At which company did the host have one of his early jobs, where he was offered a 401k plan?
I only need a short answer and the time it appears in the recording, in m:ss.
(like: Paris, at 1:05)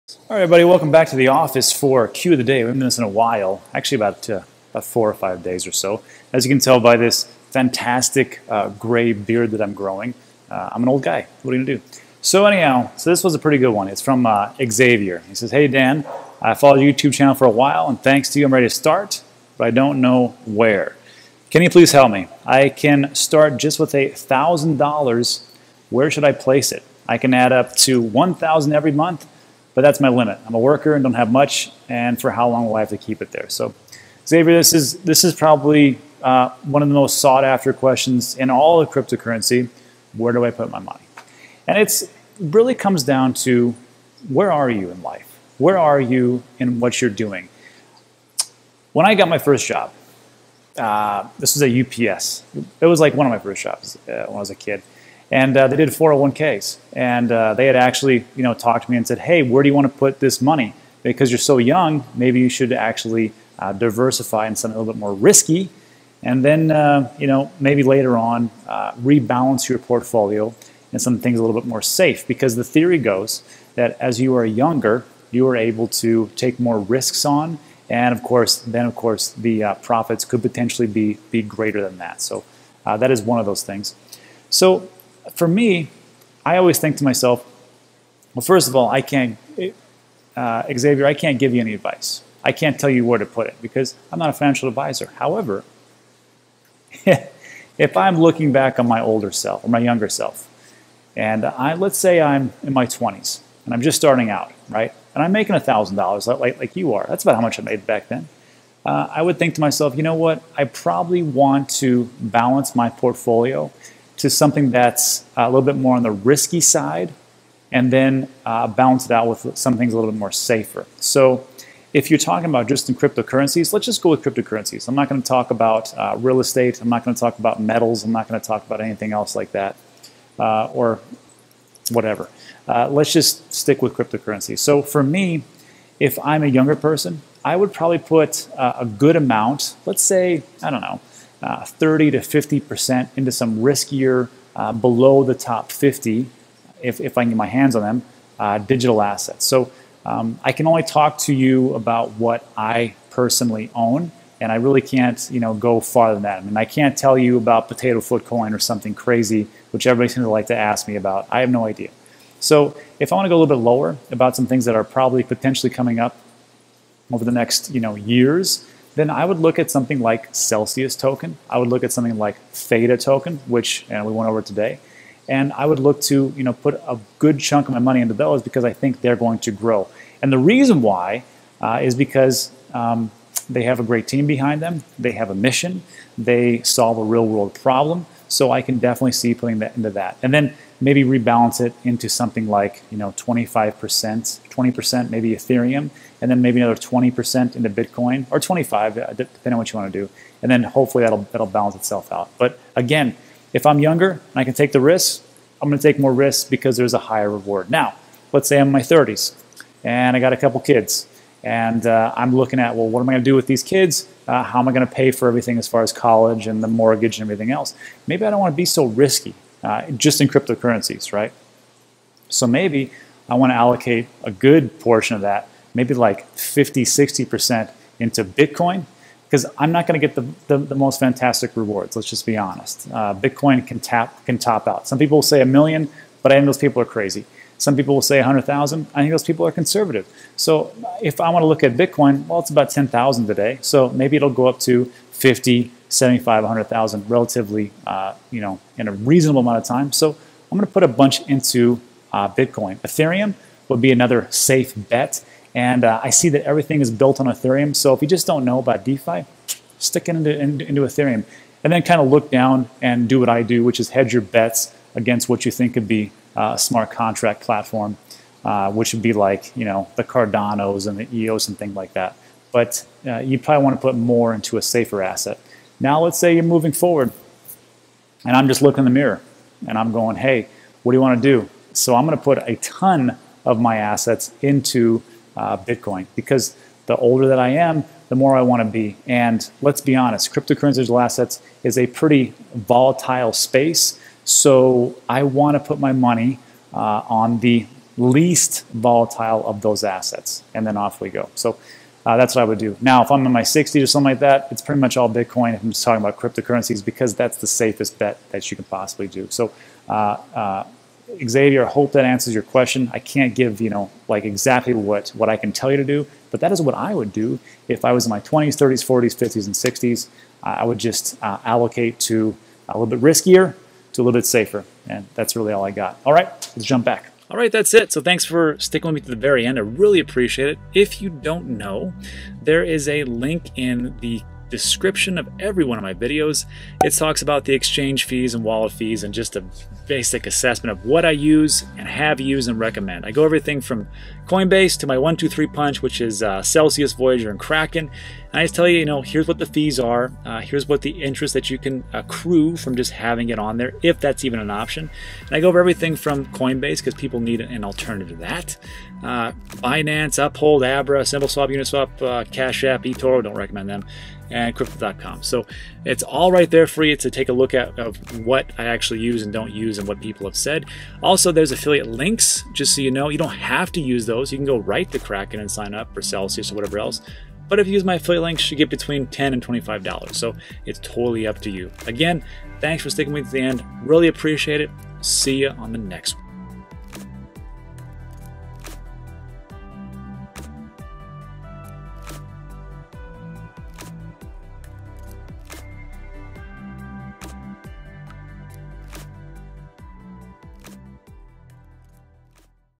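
UPS, at 0:51.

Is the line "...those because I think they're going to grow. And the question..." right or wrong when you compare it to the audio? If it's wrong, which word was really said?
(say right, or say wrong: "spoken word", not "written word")
wrong: "reason", not "question".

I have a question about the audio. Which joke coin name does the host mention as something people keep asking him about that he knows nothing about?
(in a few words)
Potato foot coin.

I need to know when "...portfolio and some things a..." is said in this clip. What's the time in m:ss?
1:09.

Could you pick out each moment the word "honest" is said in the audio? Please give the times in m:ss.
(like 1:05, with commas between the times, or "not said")
3:52, 4:49.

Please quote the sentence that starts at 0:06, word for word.
As you can tell by this fantastic uh, gray beard that I'm growing, uh, I'm an old guy.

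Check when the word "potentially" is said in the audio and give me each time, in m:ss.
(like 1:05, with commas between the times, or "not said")
1:20, 2:45.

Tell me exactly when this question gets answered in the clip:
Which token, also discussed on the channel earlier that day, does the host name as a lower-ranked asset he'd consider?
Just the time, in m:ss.
2:52.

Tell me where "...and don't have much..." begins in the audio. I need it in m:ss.
0:30.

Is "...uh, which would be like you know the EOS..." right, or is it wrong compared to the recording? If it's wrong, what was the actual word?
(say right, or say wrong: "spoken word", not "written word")
wrong: "Cardanos", not "EOS".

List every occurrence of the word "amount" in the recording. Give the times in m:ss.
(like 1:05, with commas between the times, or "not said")
2:19, 4:09.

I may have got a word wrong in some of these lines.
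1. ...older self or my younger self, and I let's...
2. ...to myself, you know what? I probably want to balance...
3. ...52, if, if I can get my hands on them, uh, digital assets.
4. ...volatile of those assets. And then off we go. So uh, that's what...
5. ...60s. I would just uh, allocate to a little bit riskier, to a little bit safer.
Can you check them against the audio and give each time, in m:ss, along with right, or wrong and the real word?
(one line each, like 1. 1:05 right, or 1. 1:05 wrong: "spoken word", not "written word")
1. 1:39 right
2. 1:49 right
3. 2:25 wrong: "50", not "52"
4. 4:58 right
5. 5:19 right.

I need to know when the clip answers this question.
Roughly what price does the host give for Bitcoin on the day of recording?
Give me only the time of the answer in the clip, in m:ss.
4:02.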